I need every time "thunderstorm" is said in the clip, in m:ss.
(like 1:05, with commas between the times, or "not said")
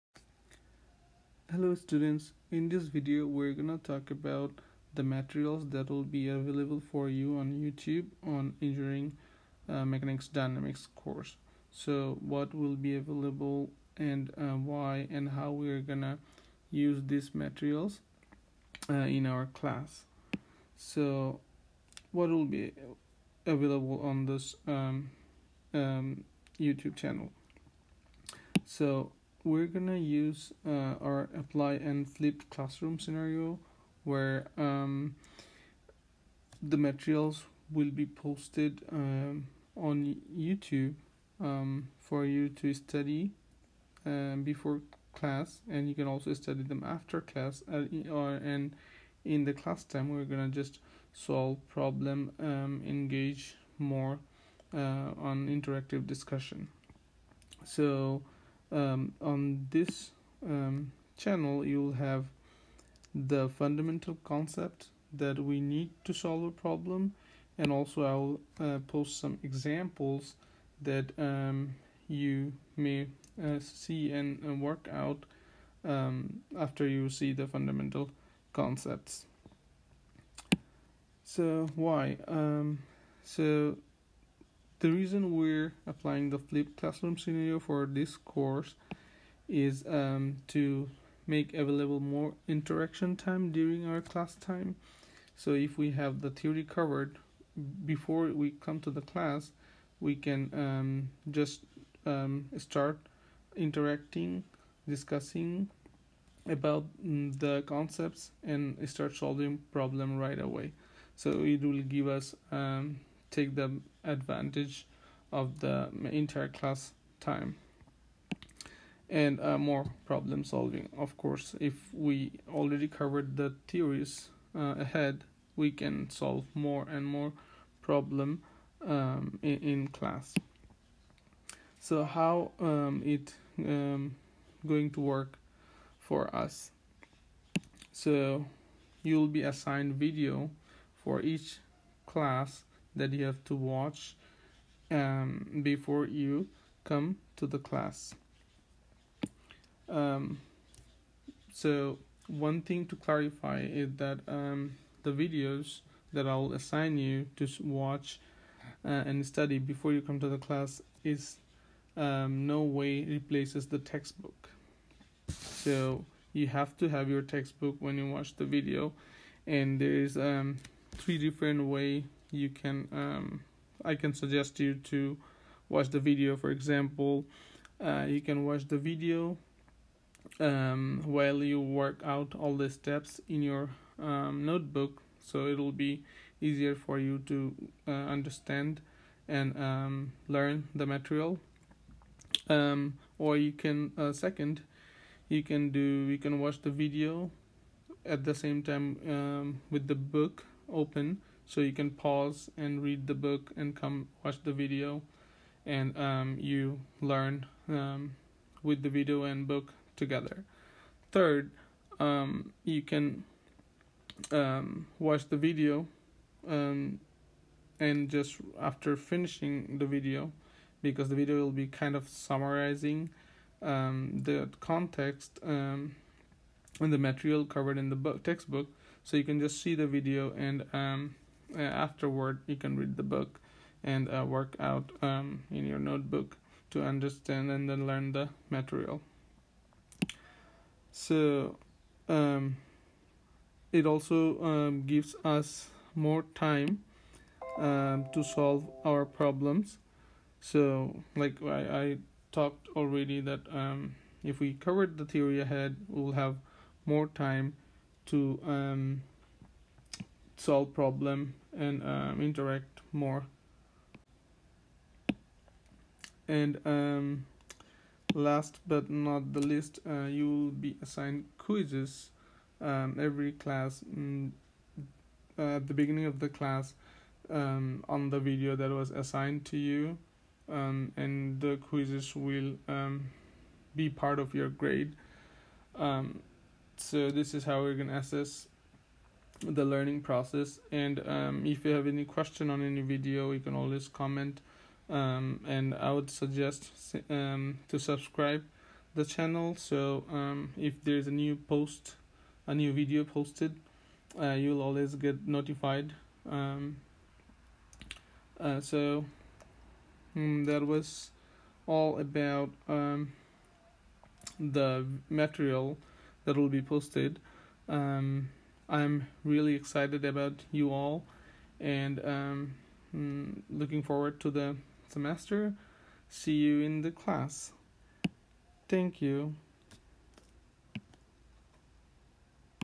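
not said.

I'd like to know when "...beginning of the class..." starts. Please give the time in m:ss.
4:35.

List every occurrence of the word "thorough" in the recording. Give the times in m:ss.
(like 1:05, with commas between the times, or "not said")
not said.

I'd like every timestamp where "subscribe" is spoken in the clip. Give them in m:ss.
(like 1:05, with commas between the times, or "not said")
4:57.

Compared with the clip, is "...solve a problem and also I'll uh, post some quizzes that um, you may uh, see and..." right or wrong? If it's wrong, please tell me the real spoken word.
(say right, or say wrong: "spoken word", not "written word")
wrong: "examples", not "quizzes".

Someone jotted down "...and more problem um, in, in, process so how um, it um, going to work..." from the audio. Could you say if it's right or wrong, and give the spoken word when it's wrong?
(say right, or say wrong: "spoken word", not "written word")
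wrong: "class", not "process".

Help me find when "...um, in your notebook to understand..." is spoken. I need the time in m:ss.
3:55.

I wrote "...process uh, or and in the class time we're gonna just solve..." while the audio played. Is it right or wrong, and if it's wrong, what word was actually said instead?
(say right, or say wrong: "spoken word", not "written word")
wrong: "class", not "process".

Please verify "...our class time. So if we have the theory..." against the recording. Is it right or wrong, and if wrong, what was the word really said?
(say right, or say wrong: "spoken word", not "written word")
right.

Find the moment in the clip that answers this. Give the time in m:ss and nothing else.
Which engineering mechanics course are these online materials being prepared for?
0:10.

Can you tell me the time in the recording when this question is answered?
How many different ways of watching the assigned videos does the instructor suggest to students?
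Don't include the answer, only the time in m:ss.
2:50.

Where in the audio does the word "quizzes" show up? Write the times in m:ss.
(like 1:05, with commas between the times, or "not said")
4:31, 4:41.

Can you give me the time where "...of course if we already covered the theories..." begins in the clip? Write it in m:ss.
2:00.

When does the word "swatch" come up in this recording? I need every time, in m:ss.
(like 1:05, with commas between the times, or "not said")
not said.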